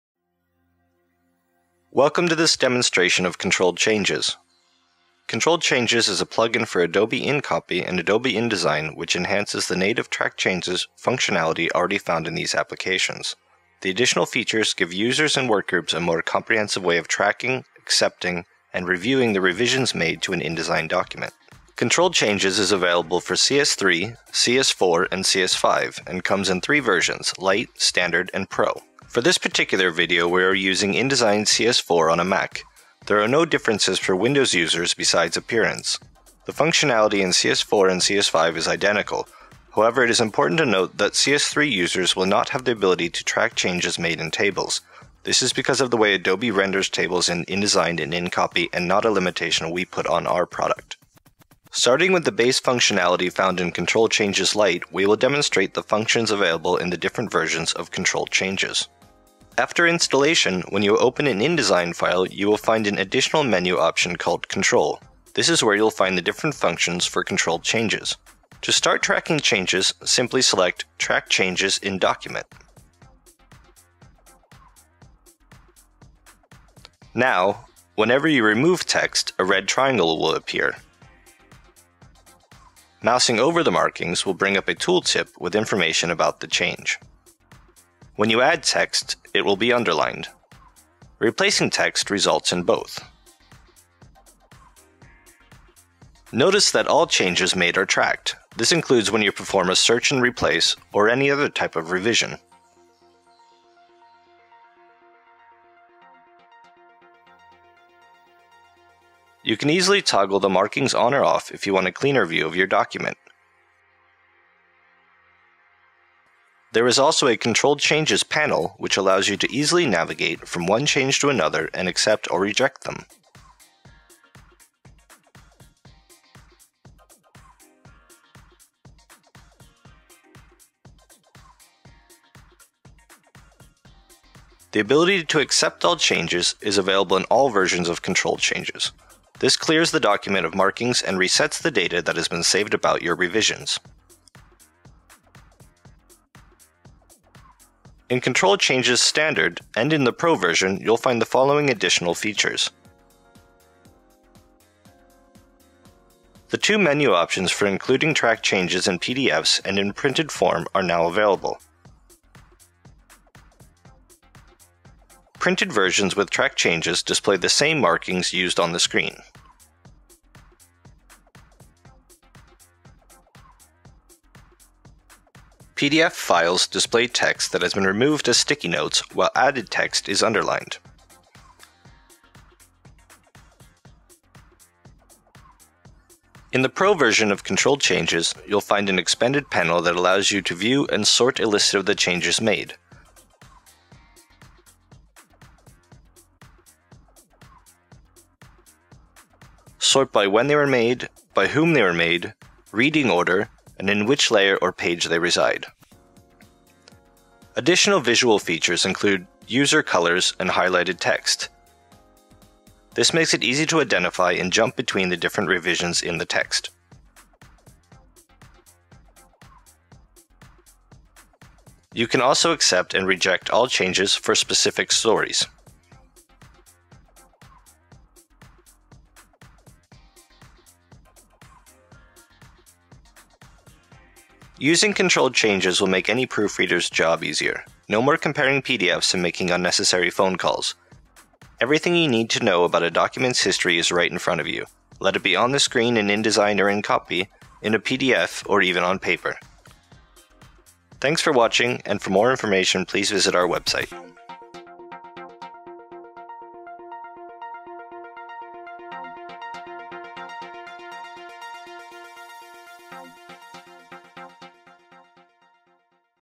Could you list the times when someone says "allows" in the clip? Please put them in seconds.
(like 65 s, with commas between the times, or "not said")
118 s, 189 s.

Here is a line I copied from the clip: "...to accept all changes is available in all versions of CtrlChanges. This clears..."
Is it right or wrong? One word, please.
right.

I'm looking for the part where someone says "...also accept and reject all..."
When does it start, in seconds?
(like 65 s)
222 s.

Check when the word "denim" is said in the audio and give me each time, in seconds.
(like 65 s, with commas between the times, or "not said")
not said.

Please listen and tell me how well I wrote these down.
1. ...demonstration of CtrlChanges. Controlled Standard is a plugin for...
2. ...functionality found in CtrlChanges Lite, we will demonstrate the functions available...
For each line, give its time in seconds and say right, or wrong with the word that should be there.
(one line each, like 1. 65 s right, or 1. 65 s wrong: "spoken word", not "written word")
1. 2 s wrong: "Changes", not "Standard"
2. 52 s right.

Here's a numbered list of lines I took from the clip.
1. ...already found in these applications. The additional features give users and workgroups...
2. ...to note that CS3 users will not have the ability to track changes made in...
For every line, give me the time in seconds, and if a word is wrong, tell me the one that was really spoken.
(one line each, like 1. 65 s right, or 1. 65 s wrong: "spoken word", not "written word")
1. 11 s right
2. 40 s right.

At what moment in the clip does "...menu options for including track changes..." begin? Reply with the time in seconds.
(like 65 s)
156 s.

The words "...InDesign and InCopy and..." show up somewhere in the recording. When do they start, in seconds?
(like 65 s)
47 s.